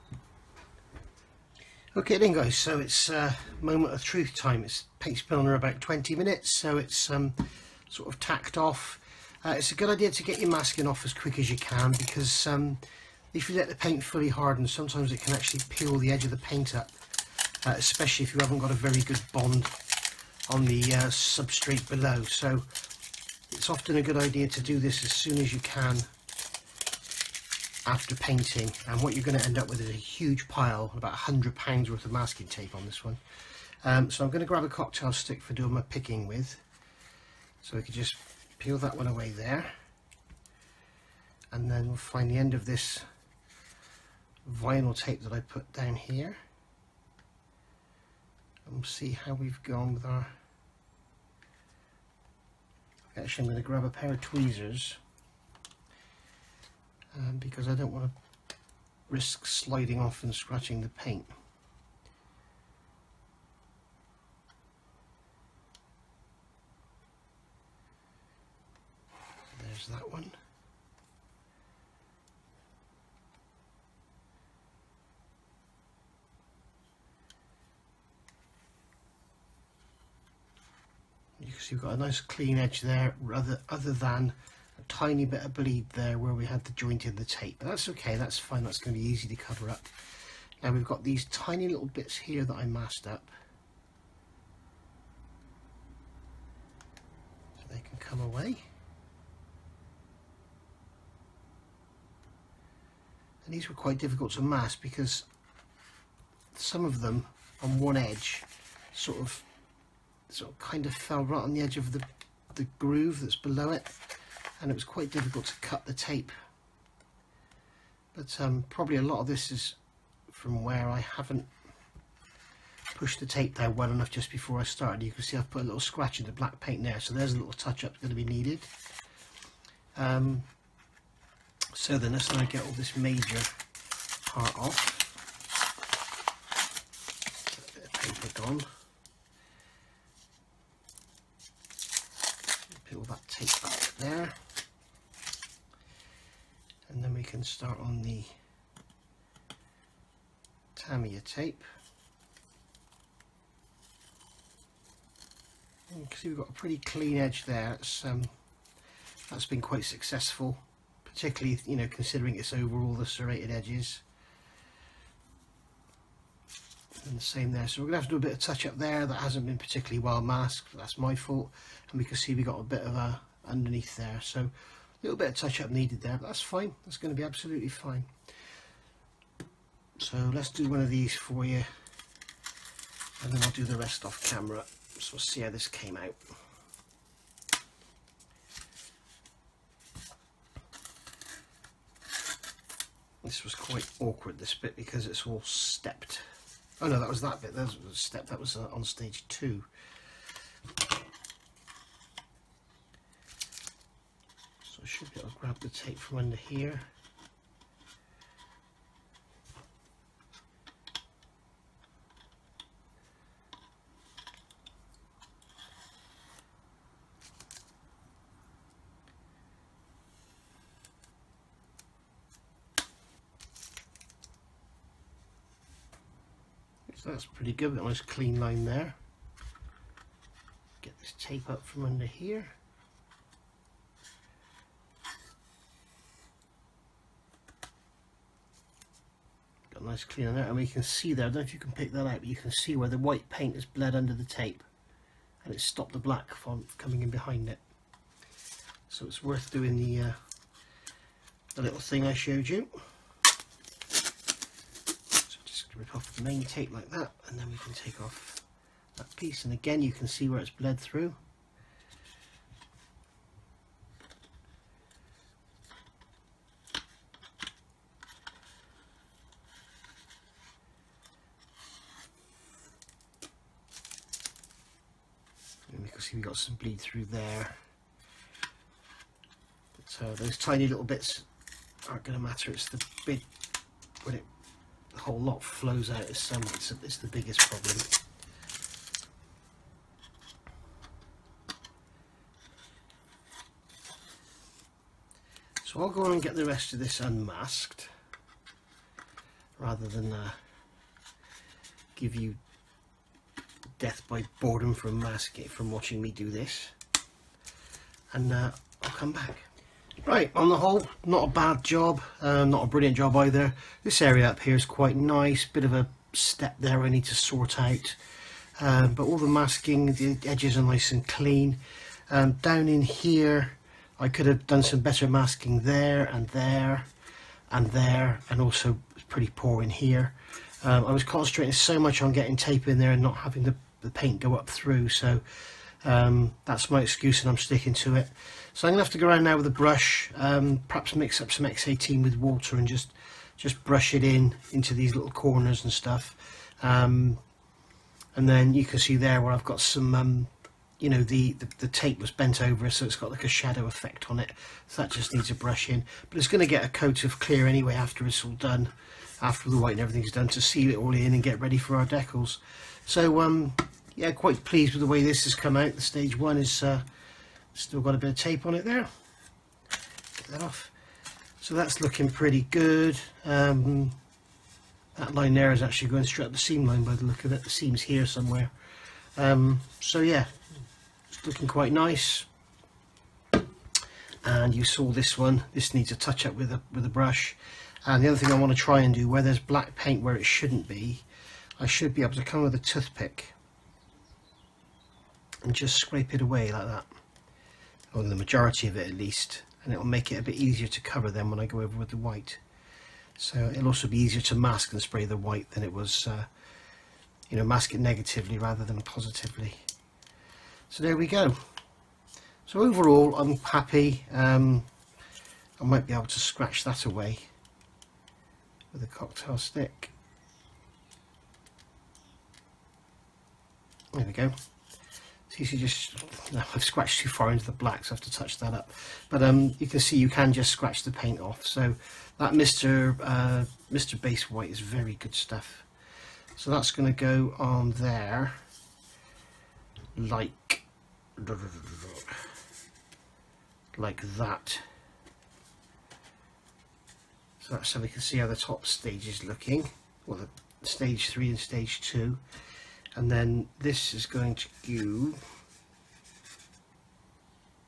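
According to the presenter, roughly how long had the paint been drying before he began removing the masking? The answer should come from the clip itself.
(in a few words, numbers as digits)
20 minutes.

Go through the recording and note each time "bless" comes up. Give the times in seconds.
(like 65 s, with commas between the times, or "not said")
not said.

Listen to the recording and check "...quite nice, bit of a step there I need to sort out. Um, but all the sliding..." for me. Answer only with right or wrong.
wrong.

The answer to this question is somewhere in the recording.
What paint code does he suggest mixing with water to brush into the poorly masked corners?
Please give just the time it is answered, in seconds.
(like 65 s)
341 s.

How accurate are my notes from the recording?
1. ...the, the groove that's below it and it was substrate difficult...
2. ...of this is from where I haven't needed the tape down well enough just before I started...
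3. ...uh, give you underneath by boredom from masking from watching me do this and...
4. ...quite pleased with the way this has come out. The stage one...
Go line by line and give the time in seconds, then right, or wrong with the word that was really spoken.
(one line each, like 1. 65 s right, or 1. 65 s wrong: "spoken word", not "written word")
1. 111 s wrong: "quite", not "substrate"
2. 119 s wrong: "pushed", not "needed"
3. 300 s wrong: "death", not "underneath"
4. 364 s right.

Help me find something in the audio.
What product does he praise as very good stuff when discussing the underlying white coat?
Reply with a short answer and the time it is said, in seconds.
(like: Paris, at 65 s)
Mr. Base White, at 433 s.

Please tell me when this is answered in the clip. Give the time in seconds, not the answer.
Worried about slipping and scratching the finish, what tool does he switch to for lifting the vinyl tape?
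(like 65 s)
54 s.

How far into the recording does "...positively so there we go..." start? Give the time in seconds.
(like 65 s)
408 s.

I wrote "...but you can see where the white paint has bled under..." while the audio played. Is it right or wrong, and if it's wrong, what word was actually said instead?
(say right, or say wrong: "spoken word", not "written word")
right.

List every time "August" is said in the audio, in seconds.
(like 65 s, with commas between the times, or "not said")
not said.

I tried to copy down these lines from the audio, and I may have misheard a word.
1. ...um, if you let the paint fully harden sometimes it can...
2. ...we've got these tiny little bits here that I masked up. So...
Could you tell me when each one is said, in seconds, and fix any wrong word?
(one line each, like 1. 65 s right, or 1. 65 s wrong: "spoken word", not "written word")
1. 12 s right
2. 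90 s right.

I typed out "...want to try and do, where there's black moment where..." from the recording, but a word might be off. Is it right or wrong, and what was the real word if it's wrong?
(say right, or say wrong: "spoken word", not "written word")
wrong: "paint", not "moment".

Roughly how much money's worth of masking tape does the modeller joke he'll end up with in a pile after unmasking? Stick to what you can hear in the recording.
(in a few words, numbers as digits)
100 pounds.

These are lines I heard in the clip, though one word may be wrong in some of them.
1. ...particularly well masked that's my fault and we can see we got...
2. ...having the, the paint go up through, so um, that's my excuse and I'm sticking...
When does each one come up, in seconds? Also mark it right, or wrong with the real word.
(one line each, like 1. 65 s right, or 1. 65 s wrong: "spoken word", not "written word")
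1. 169 s right
2. 333 s right.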